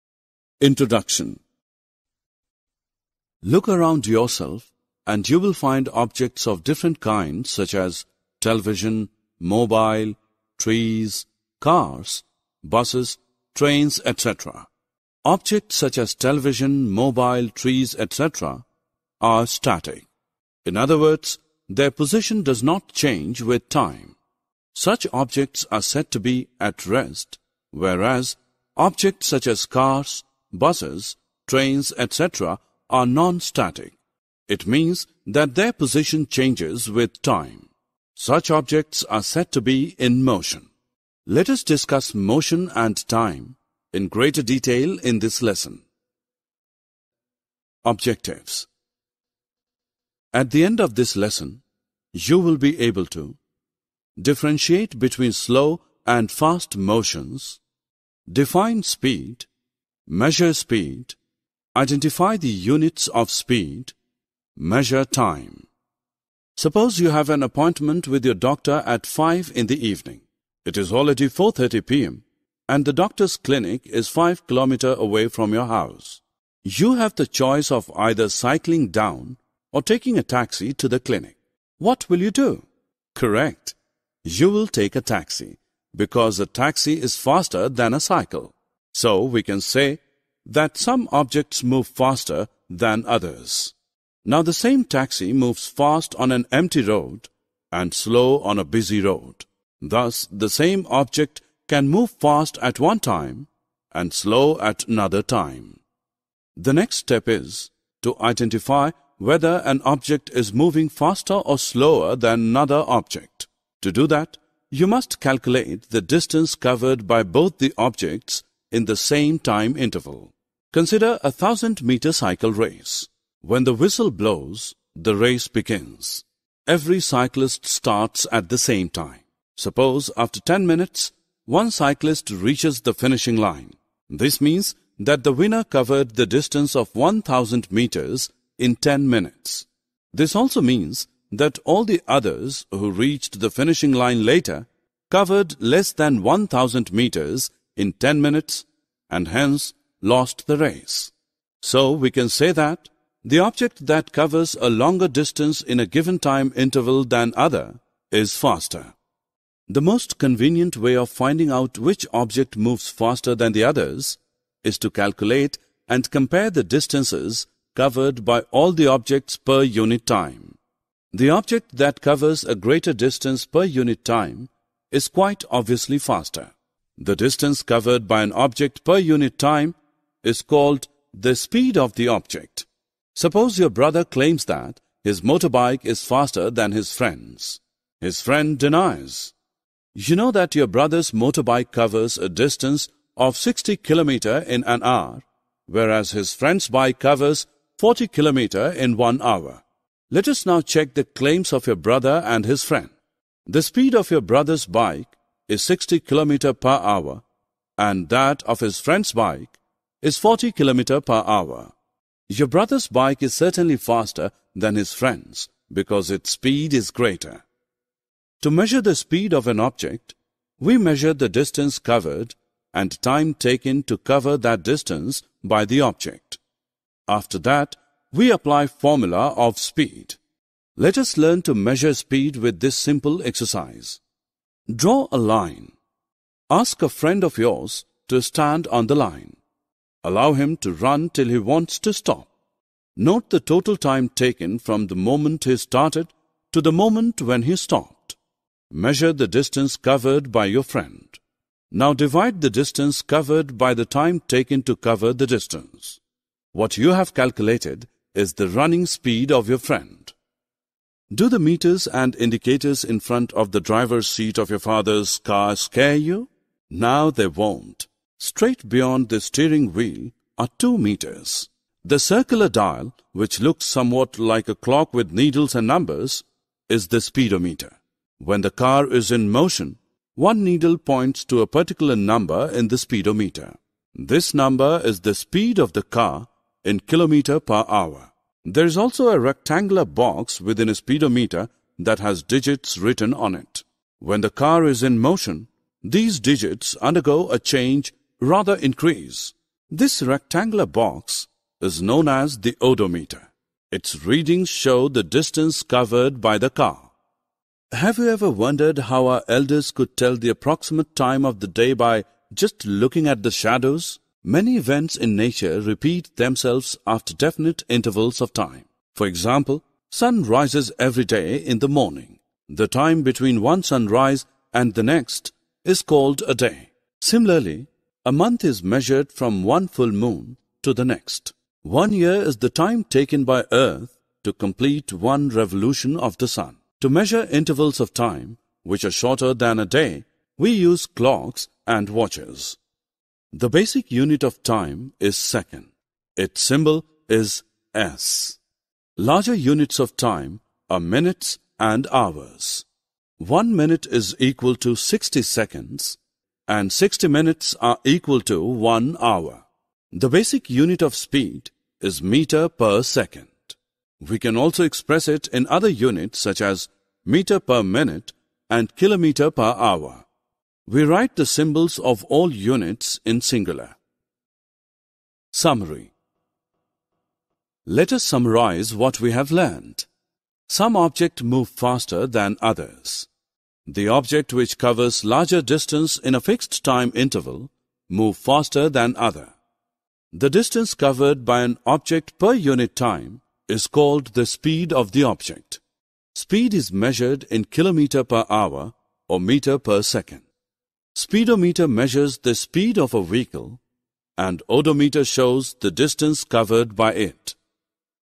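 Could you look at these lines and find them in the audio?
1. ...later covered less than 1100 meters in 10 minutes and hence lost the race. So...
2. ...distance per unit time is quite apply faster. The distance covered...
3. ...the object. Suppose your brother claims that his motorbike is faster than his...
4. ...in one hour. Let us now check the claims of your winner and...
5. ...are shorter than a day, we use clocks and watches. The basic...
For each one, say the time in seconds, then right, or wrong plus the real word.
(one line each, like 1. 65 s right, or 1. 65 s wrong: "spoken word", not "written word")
1. 144 s wrong: "1000", not "1100"
2. 172 s wrong: "obviously", not "apply"
3. 181 s right
4. 198 s wrong: "brother", not "winner"
5. 338 s right.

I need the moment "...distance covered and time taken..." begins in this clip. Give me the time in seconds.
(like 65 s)
221 s.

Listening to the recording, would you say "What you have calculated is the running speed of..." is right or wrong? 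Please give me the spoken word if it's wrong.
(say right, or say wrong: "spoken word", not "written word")
right.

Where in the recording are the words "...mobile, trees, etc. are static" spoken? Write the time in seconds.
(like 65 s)
16 s.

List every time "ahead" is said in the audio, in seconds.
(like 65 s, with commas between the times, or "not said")
not said.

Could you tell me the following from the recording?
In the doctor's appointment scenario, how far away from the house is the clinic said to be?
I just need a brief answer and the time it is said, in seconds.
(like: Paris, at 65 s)
5 kilometers, at 74 s.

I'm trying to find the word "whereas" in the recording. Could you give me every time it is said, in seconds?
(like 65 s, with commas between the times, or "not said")
27 s, 195 s.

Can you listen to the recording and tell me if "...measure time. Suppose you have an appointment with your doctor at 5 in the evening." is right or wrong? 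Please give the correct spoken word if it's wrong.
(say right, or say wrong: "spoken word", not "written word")
right.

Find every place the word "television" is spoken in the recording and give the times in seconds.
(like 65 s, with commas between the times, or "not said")
8 s, 16 s.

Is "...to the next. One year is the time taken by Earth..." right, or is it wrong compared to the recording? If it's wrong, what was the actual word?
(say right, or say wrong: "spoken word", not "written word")
right.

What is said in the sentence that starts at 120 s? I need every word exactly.
Consider a thousand meter cycle race.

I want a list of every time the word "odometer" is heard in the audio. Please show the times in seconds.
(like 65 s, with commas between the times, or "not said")
302 s, 404 s.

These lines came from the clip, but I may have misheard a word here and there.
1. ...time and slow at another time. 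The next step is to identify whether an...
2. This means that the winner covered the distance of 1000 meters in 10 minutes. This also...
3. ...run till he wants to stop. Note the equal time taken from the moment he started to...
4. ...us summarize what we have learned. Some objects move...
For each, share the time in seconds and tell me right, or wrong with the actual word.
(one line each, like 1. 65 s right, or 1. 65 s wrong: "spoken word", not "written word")
1. 102 s right
2. 134 s right
3. 240 s wrong: "total", not "equal"
4. 377 s right.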